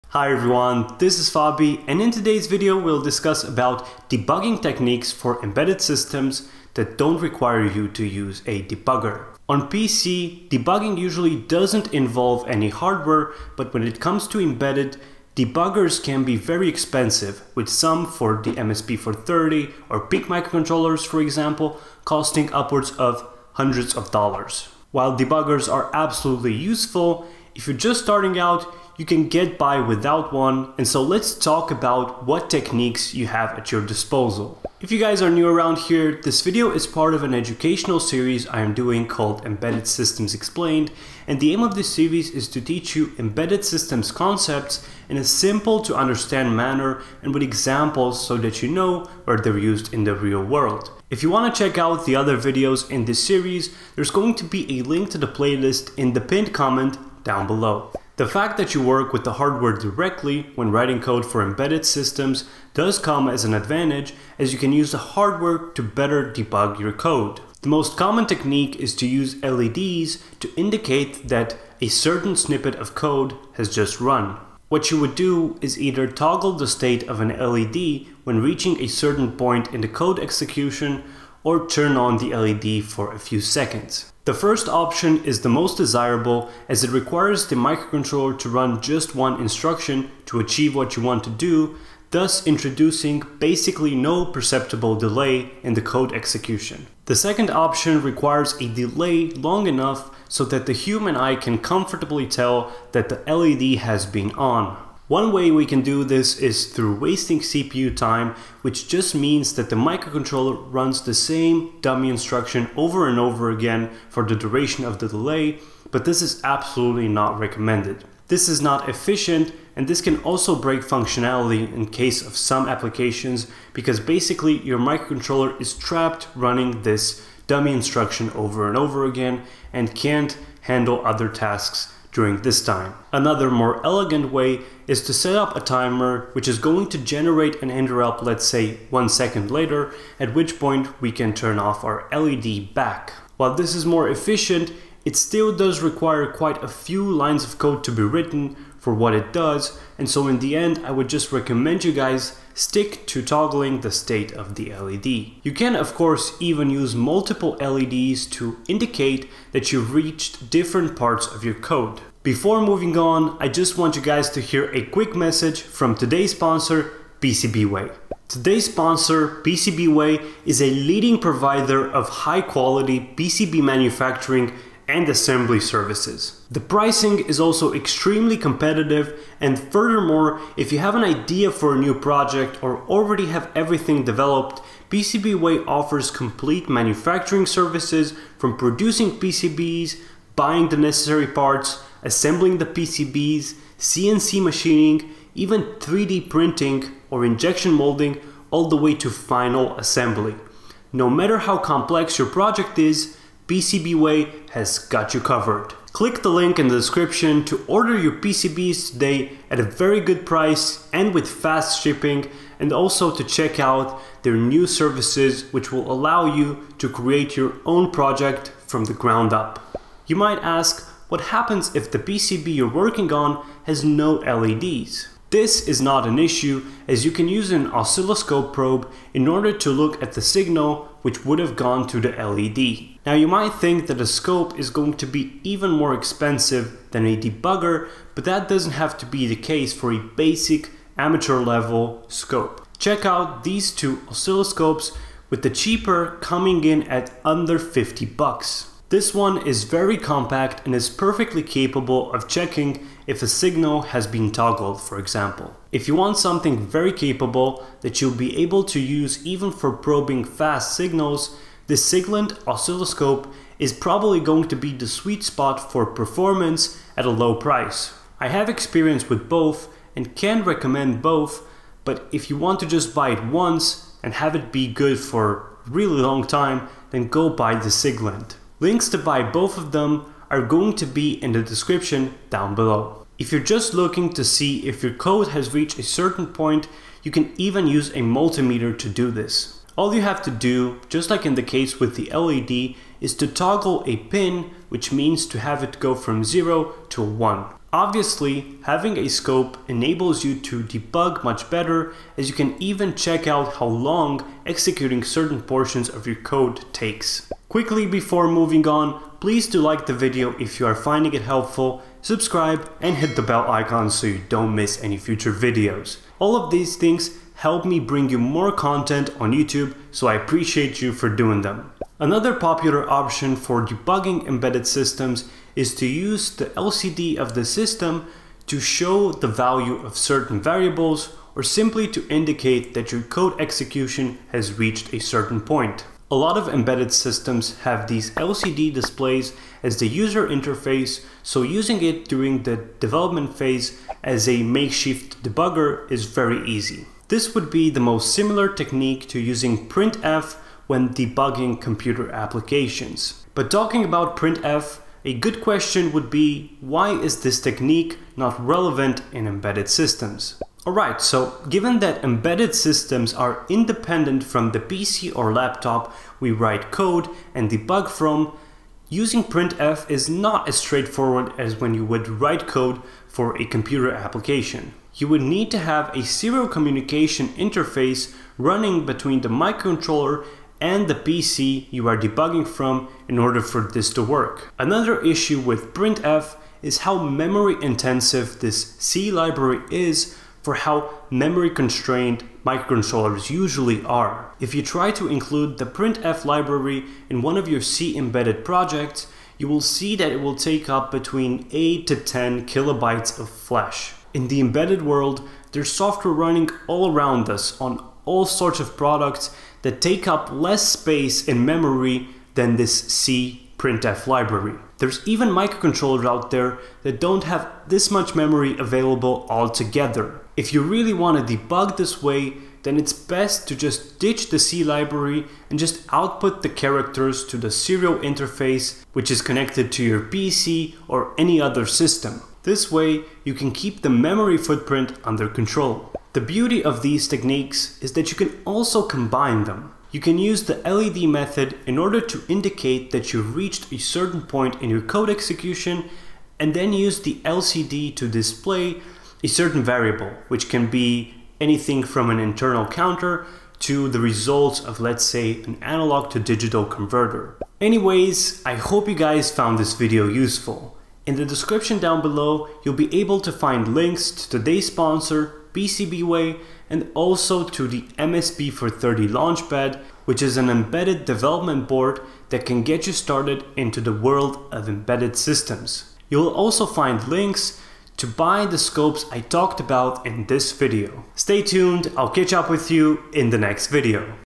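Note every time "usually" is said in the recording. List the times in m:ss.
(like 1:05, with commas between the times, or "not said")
0:10, 6:33.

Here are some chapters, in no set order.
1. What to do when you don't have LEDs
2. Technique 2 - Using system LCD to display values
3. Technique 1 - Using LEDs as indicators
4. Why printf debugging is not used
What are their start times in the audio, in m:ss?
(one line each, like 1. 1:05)
1. 3:40
2. 5:21
3. 0:58
4. 6:00.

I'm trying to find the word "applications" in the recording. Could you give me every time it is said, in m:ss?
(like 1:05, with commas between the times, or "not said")
2:02, 5:52, 6:13.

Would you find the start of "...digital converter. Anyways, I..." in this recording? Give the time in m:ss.
7:36.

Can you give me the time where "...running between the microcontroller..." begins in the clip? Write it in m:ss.
6:18.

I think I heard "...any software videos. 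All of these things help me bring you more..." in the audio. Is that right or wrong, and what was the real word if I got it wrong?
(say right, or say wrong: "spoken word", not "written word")
wrong: "future", not "software".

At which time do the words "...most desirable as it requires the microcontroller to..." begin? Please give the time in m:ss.
1:25.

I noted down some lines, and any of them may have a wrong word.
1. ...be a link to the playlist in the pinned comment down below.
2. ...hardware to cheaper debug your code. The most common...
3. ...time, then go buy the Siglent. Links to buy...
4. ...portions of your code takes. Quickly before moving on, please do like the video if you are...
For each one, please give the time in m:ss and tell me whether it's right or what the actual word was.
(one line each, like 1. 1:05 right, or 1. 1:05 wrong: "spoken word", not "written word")
1. 0:54 right
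2. 1:04 wrong: "better", not "cheaper"
3. 4:36 right
4. 5:05 right.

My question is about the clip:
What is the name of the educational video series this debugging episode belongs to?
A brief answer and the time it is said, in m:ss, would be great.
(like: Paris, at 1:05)
Embedded Systems Explained, at 0:39.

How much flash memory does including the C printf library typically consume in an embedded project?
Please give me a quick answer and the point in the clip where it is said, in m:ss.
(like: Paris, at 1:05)
8 to 10 kilobytes, at 6:41.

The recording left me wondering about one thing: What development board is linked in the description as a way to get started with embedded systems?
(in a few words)
MSP430 Launchpad.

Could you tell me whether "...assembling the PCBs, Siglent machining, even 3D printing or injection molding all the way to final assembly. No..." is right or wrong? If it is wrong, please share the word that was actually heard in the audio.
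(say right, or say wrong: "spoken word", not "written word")
wrong: "CNC", not "Siglent".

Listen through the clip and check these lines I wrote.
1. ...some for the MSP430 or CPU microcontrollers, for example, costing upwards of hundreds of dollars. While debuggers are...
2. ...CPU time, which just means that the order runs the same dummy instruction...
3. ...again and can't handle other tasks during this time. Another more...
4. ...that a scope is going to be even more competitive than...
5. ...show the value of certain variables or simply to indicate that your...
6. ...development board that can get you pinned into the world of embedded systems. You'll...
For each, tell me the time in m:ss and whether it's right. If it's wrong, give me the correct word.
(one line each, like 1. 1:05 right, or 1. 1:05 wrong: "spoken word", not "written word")
1. 0:17 wrong: "PIC", not "CPU"
2. 1:47 wrong: "microcontroller", not "order"
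3. 2:09 right
4. 3:53 wrong: "expensive", not "competitive"
5. 5:28 right
6. 7:51 wrong: "started", not "pinned".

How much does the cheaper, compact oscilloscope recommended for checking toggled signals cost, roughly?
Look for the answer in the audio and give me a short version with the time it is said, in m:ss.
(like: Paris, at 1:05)
under 50 bucks, at 4:07.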